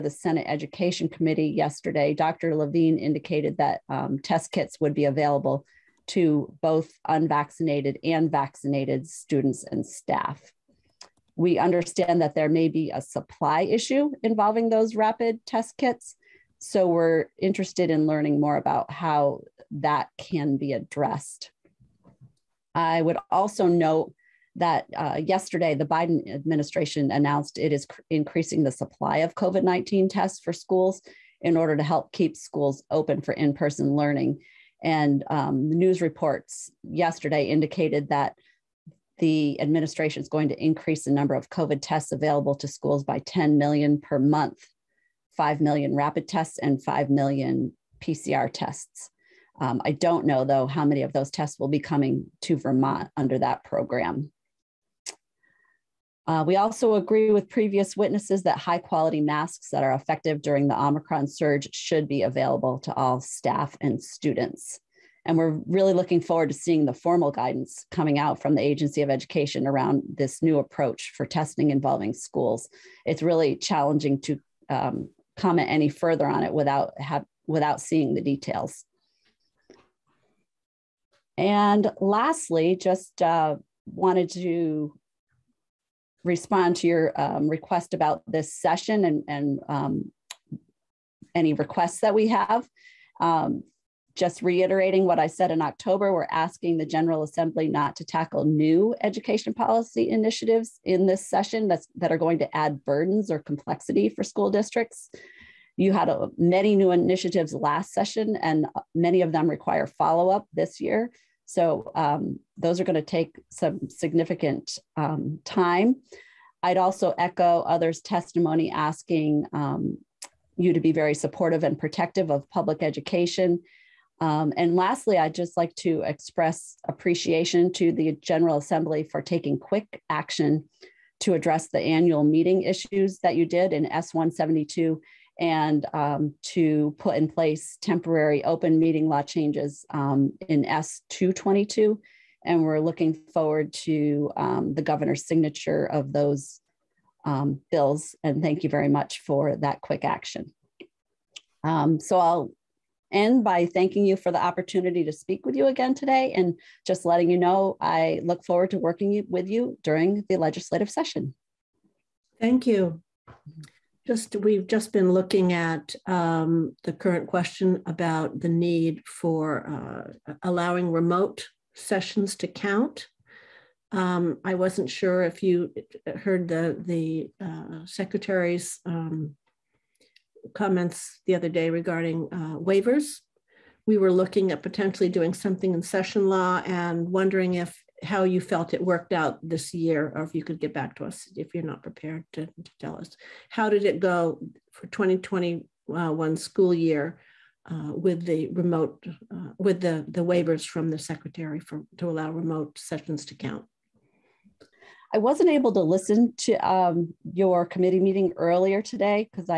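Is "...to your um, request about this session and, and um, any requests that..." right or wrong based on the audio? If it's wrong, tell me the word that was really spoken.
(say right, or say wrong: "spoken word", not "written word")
right.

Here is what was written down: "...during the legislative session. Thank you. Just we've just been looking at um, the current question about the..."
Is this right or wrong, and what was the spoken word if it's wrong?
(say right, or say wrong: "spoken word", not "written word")
right.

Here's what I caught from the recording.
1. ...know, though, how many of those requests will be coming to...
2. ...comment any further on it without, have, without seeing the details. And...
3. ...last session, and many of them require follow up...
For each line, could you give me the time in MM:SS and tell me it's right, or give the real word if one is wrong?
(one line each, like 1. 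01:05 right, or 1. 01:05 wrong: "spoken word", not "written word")
1. 00:50 wrong: "tests", not "requests"
2. 01:15 right
3. 01:47 right.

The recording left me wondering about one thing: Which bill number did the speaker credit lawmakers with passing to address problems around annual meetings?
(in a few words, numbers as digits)
S172.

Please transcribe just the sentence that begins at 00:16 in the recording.
So we're interested in learning more about how that can be addressed.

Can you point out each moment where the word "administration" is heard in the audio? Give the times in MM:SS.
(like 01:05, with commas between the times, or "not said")
00:26, 00:39.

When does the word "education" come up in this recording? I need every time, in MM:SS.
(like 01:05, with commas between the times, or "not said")
00:00, 01:09, 01:39, 02:02.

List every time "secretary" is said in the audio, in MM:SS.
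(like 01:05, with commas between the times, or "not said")
02:57, 03:20.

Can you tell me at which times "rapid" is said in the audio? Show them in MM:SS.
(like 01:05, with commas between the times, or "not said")
00:14, 00:45.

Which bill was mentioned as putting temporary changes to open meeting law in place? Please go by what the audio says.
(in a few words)
S222.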